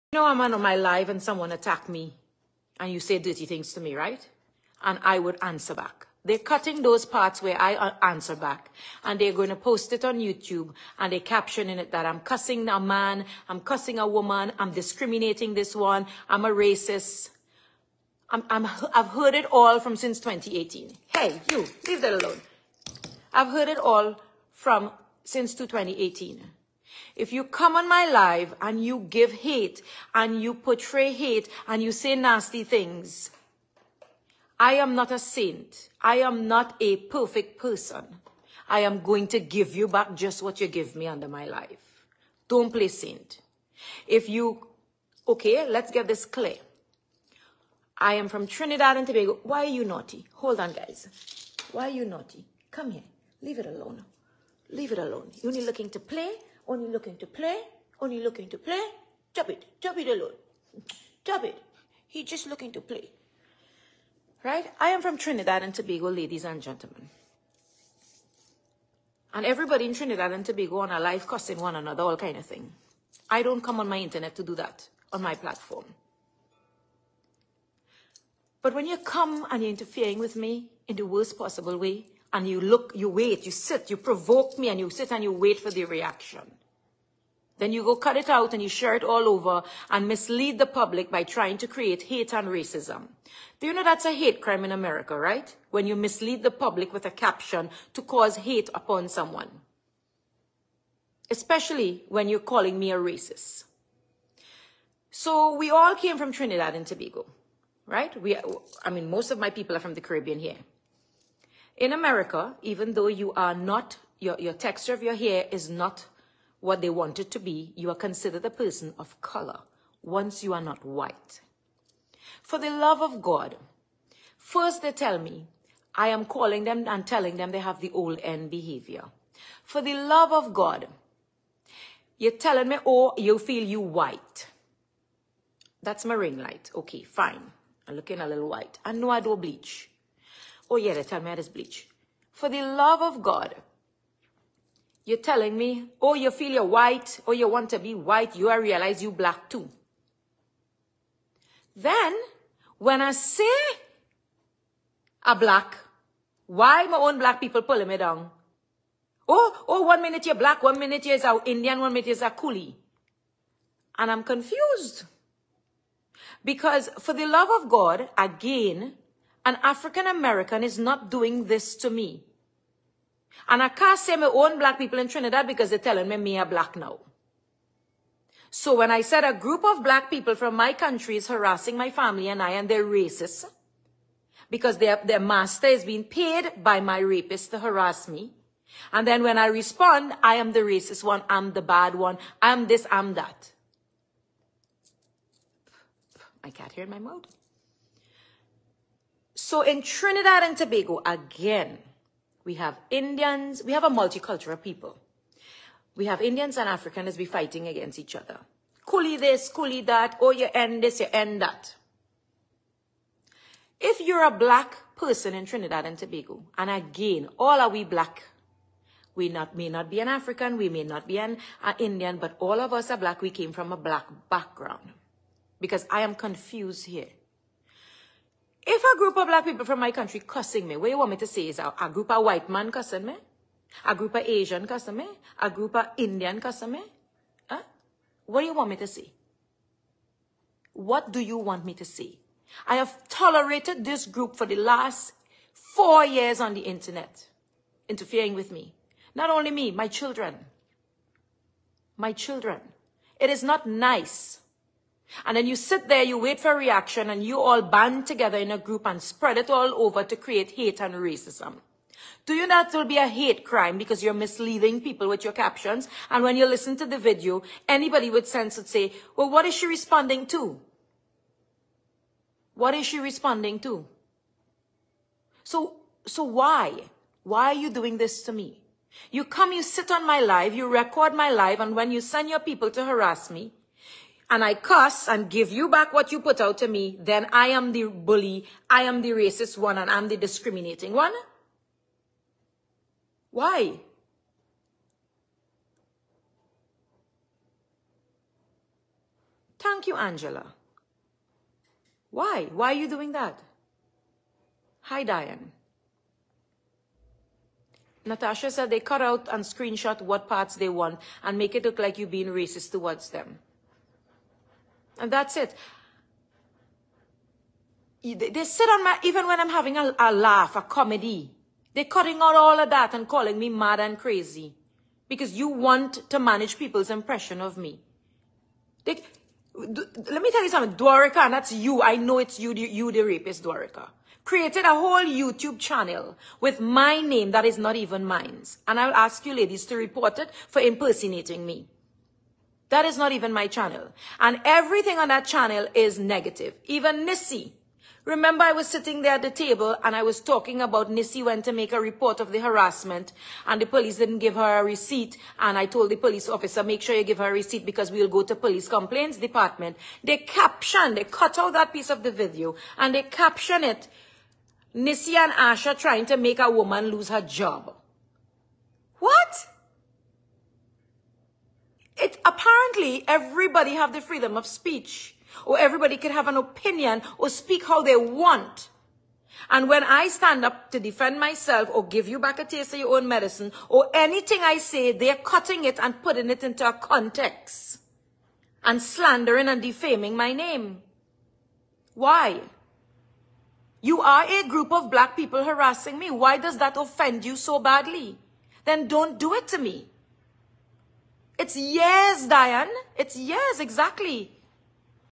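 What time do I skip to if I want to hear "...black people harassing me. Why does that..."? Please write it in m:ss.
6:34.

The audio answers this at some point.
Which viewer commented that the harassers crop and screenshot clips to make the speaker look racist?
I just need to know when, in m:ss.
5:08.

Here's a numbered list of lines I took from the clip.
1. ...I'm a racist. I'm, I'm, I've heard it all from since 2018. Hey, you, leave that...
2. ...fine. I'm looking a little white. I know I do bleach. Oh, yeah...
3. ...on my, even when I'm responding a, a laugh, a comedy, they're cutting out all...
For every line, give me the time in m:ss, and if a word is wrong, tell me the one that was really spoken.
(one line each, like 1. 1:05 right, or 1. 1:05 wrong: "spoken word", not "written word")
1. 0:16 right
2. 2:17 right
3. 5:18 wrong: "having", not "responding".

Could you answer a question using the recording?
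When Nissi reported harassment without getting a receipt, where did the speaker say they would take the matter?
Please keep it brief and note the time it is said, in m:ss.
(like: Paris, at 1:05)
police complaints department, at 5:58.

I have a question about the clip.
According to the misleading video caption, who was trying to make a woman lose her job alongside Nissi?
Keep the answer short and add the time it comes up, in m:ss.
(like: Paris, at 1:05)
Asha, at 6:05.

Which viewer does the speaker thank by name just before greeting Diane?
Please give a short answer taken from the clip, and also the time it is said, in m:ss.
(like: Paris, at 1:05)
Angela, at 4:59.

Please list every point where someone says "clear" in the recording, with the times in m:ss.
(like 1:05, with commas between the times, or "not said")
0:46.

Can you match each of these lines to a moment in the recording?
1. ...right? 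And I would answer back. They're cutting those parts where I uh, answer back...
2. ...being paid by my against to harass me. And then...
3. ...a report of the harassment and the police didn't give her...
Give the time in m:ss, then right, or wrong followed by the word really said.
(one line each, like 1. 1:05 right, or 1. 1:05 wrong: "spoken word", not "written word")
1. 0:03 right
2. 3:05 wrong: "rapist", not "against"
3. 5:51 right.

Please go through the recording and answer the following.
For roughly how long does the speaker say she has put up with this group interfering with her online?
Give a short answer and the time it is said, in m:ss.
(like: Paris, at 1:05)
4 years, at 4:05.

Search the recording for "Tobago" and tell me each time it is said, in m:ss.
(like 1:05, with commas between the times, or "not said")
0:49, 1:05, 1:10, 1:46, 3:20, 3:35.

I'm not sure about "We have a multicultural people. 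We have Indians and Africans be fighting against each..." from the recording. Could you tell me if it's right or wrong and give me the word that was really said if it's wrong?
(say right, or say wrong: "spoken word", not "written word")
right.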